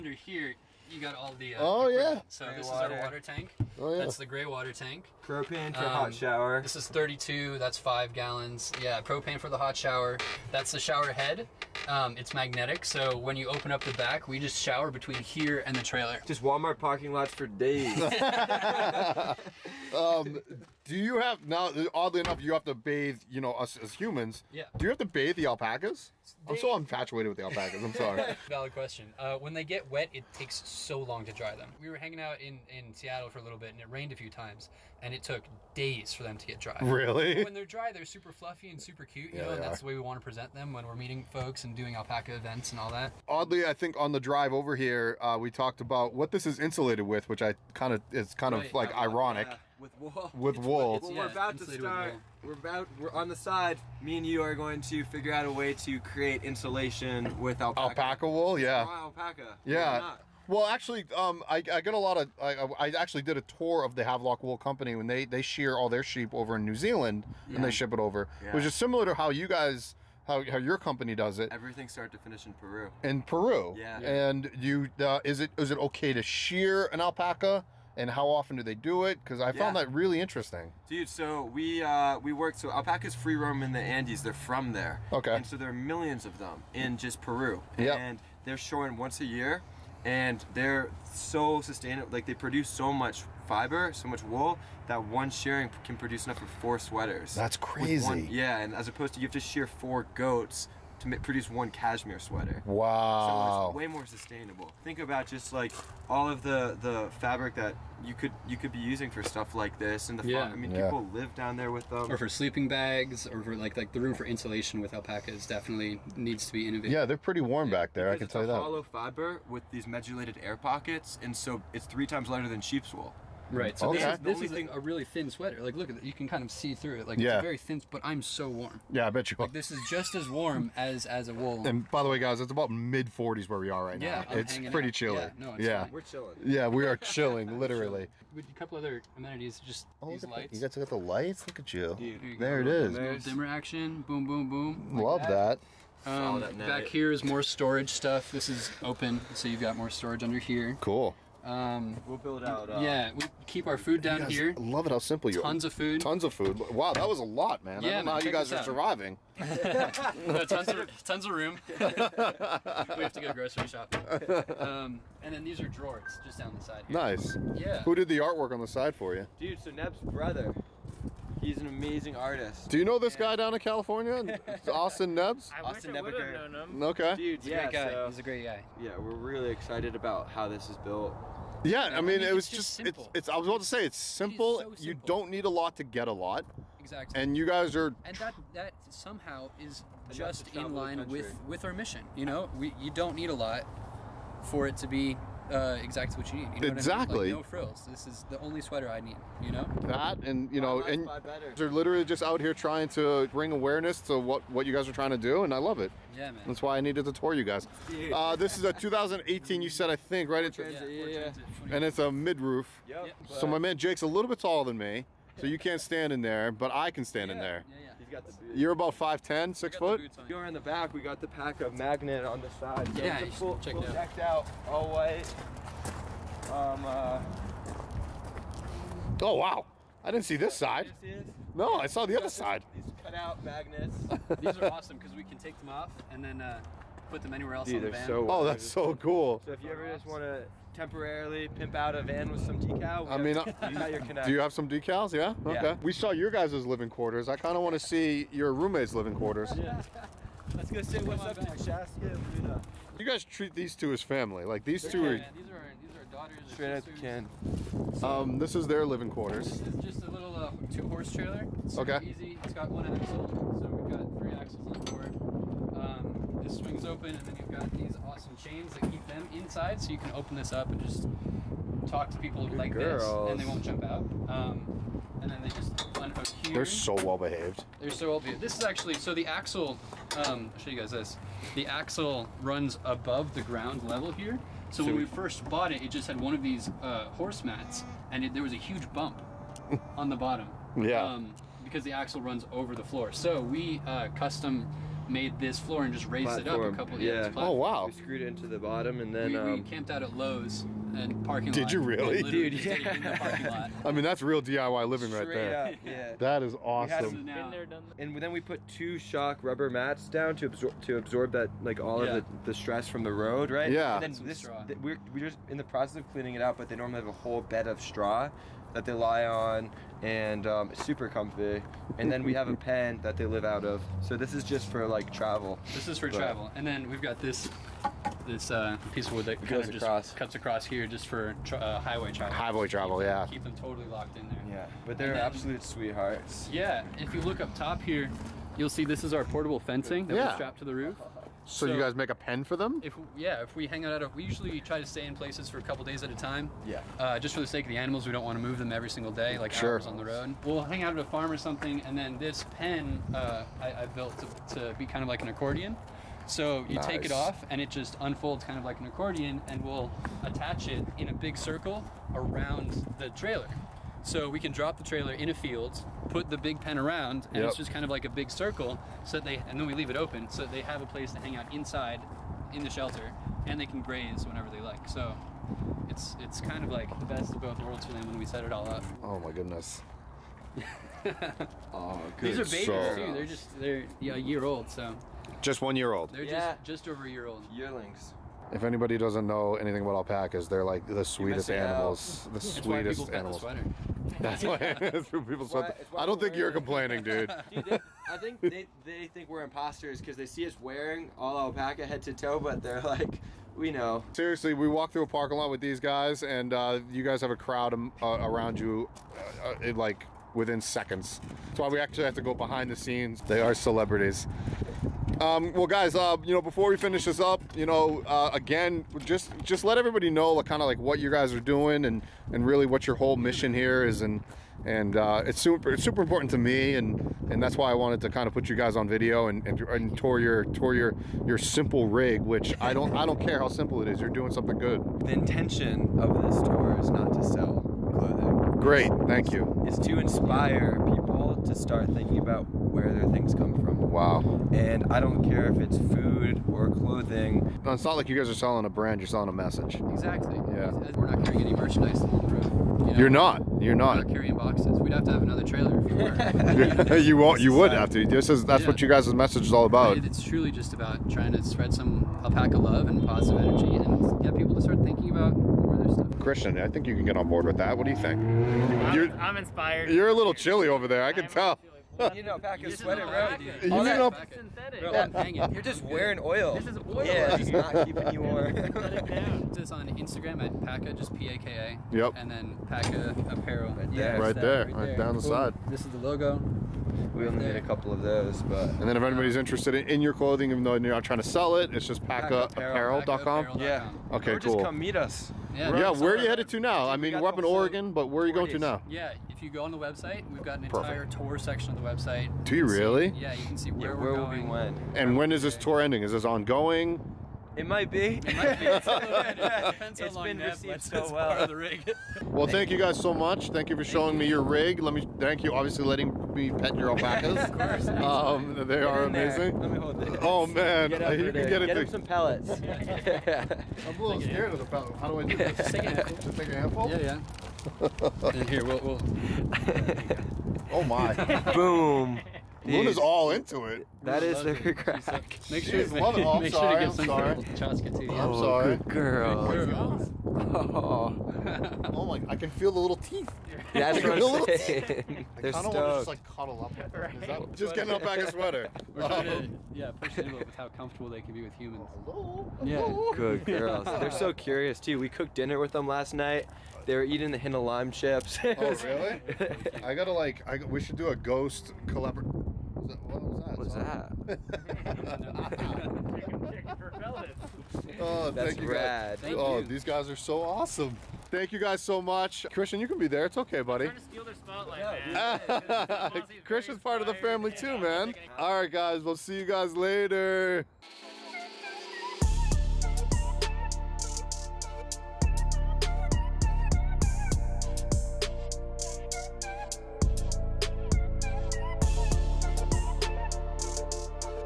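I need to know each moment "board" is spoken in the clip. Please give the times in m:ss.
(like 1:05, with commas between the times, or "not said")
7:47.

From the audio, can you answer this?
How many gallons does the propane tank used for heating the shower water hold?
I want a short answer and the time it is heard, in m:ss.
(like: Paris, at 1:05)
5, at 0:07.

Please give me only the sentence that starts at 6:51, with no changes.
That's why we actually have to go behind the scenes.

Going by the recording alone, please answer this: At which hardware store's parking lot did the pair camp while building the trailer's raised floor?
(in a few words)
Lowe's.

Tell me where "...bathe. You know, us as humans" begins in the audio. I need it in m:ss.
0:22.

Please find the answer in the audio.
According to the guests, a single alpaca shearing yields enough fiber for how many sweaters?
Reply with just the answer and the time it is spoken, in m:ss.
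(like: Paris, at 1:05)
4, at 1:36.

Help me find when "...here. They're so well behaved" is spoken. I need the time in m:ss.
4:36.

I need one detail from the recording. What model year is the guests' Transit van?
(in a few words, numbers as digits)
2018.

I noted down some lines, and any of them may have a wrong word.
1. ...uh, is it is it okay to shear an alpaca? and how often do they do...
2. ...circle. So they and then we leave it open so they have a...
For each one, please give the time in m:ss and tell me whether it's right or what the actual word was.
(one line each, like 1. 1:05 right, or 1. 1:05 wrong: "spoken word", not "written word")
1. 1:14 right
2. 6:08 right.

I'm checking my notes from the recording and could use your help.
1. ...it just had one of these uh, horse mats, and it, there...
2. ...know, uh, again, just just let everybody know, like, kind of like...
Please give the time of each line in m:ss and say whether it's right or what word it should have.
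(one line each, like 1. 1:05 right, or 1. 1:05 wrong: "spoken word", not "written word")
1. 4:45 right
2. 6:57 right.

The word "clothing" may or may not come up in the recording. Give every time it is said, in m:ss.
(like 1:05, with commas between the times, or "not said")
7:17, 7:26, 8:10.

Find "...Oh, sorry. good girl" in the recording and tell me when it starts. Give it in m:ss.
8:58.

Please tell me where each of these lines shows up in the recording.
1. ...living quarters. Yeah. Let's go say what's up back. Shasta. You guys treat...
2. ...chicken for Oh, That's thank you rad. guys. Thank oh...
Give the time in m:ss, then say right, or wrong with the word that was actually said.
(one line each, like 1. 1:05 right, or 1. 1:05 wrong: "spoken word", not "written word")
1. 4:08 right
2. 9:26 right.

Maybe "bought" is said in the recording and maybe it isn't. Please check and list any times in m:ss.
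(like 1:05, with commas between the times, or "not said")
4:45.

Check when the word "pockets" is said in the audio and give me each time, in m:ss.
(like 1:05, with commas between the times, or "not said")
2:00.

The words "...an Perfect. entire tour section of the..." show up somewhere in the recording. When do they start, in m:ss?
8:20.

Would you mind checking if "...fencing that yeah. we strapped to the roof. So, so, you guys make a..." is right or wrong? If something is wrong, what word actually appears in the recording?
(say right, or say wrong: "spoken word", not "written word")
right.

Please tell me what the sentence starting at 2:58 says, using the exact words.
Yeah, we're really excited about how this is built.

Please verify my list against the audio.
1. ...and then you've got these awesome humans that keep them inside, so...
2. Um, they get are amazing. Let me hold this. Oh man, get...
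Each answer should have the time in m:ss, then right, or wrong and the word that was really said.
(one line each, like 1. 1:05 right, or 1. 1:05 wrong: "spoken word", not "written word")
1. 4:27 wrong: "chains", not "humans"
2. 8:37 right.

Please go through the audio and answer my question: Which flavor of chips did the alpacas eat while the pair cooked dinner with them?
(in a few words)
Hint of lime.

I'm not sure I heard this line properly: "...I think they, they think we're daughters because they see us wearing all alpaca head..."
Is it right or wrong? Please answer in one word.
wrong.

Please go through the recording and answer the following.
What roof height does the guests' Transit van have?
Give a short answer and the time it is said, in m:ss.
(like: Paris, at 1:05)
Mid roof, at 3:32.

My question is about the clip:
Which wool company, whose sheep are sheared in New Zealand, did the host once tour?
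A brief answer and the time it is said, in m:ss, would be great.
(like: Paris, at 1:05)
Havelock Wool Company, at 1:04.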